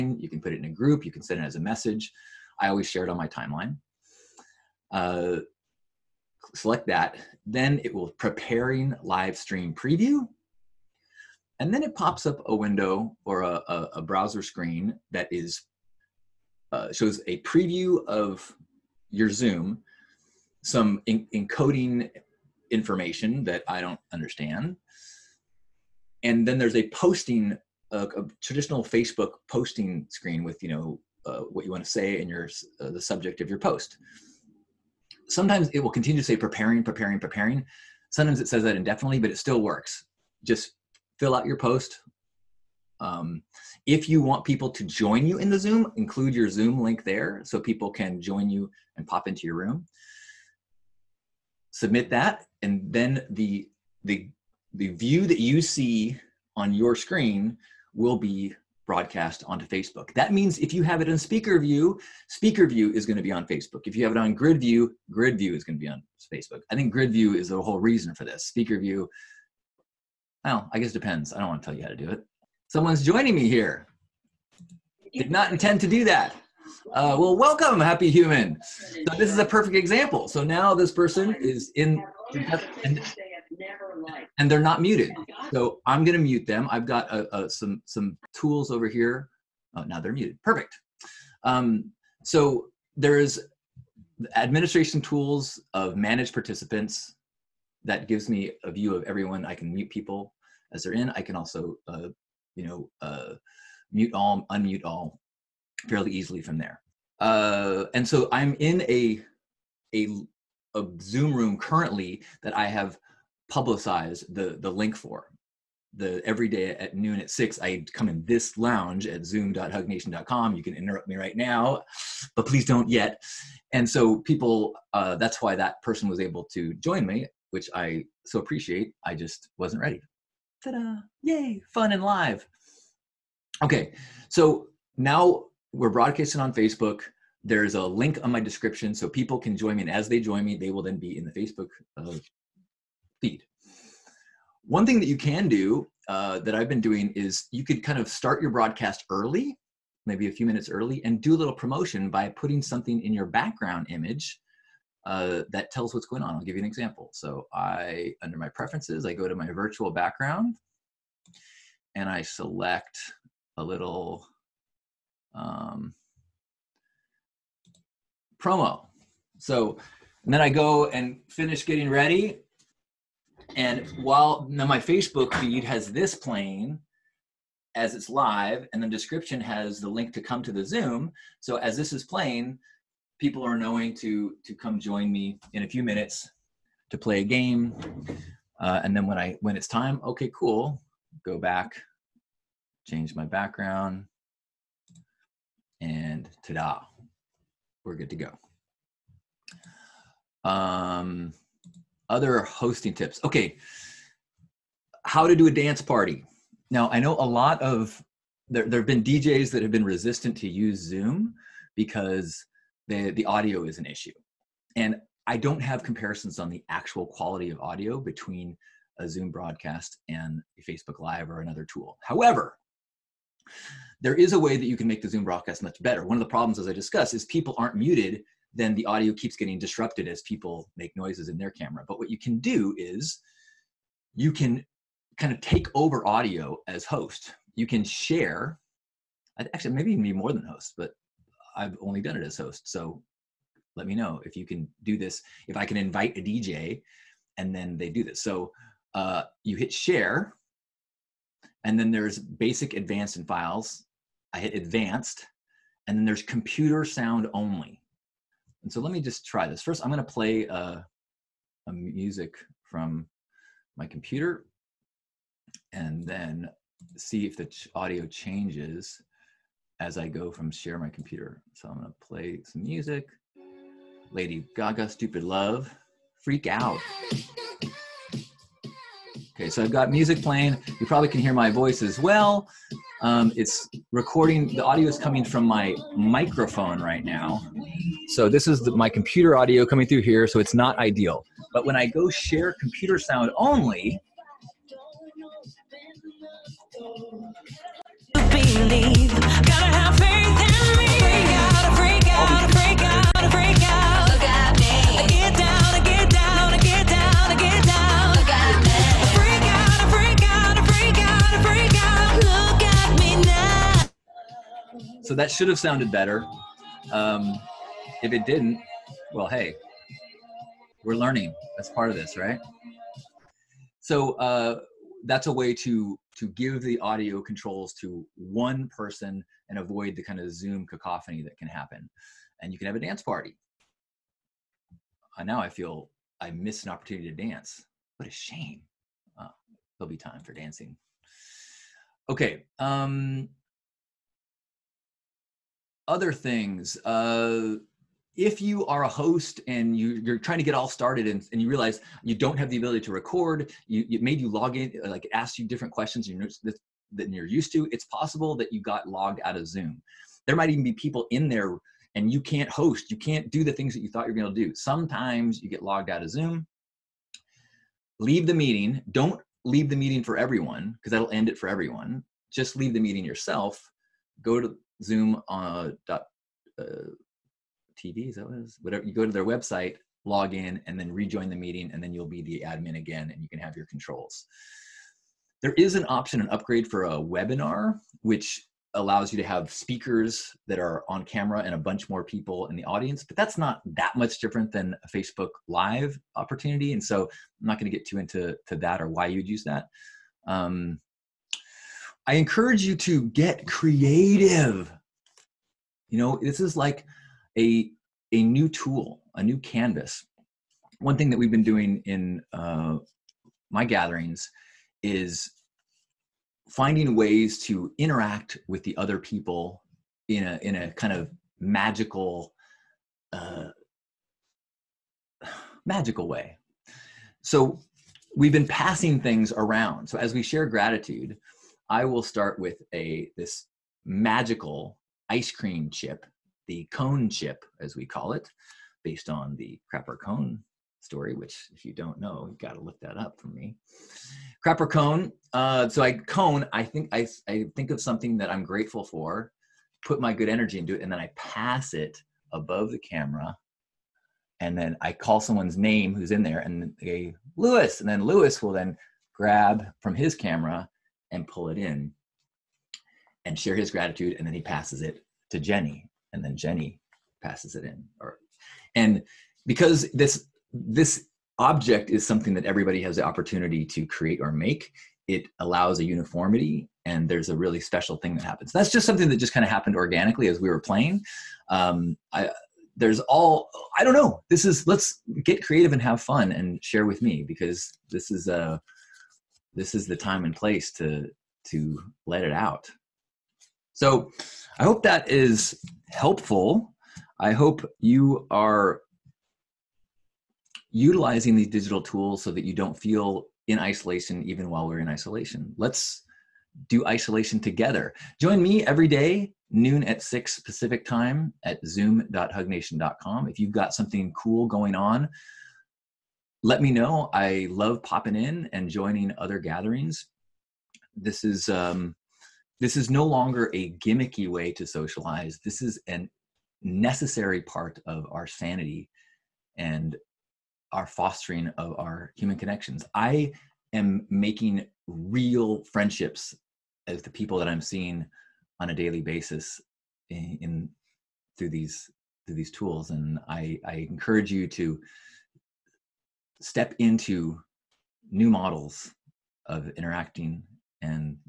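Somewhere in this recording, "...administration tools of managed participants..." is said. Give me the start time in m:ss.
1:34.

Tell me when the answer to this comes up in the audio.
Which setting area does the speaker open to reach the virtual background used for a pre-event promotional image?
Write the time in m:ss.
2:38.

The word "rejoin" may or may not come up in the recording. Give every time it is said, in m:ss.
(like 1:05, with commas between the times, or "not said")
6:20.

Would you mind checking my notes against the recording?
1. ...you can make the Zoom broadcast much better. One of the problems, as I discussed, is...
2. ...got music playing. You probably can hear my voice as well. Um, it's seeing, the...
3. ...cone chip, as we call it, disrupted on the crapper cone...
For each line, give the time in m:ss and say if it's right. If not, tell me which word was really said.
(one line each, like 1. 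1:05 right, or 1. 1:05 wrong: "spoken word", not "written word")
1. 3:44 right
2. 4:39 wrong: "recording", not "seeing"
3. 7:16 wrong: "based", not "disrupted".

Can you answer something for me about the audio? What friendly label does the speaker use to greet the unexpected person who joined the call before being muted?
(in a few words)
happy human.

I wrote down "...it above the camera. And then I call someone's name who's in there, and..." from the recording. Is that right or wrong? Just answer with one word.
right.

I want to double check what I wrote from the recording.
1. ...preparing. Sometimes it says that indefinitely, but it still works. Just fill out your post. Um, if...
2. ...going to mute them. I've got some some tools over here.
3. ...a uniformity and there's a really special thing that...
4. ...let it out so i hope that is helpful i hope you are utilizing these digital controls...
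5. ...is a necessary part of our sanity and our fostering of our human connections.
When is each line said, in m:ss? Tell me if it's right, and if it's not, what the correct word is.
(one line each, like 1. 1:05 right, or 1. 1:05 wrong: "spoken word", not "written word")
1. 0:37 right
2. 1:26 right
3. 7:55 right
4. 8:12 wrong: "tools", not "controls"
5. 8:45 right.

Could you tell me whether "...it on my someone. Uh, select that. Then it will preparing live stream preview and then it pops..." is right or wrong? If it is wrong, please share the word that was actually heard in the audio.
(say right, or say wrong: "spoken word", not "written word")
wrong: "timeline", not "someone".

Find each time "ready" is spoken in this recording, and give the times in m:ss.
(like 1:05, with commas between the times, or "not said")
2:09, 2:51.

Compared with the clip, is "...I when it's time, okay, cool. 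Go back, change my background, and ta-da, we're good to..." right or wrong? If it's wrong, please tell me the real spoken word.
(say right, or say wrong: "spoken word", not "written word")
right.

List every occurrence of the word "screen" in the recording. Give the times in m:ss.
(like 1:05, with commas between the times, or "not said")
0:14, 0:30, 0:56.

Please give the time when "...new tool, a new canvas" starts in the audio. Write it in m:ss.
6:48.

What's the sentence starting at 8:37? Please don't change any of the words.
I love popping in and joining other gatherings.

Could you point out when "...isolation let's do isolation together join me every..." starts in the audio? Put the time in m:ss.
8:24.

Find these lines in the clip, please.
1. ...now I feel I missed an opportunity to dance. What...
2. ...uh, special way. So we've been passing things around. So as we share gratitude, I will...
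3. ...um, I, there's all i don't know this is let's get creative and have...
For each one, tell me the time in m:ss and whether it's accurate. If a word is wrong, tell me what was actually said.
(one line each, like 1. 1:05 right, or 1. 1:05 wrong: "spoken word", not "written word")
1. 5:35 right
2. 7:03 wrong: "magical", not "special"
3. 8:01 right.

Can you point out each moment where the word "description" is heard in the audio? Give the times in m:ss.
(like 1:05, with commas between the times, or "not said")
2:18, 2:58.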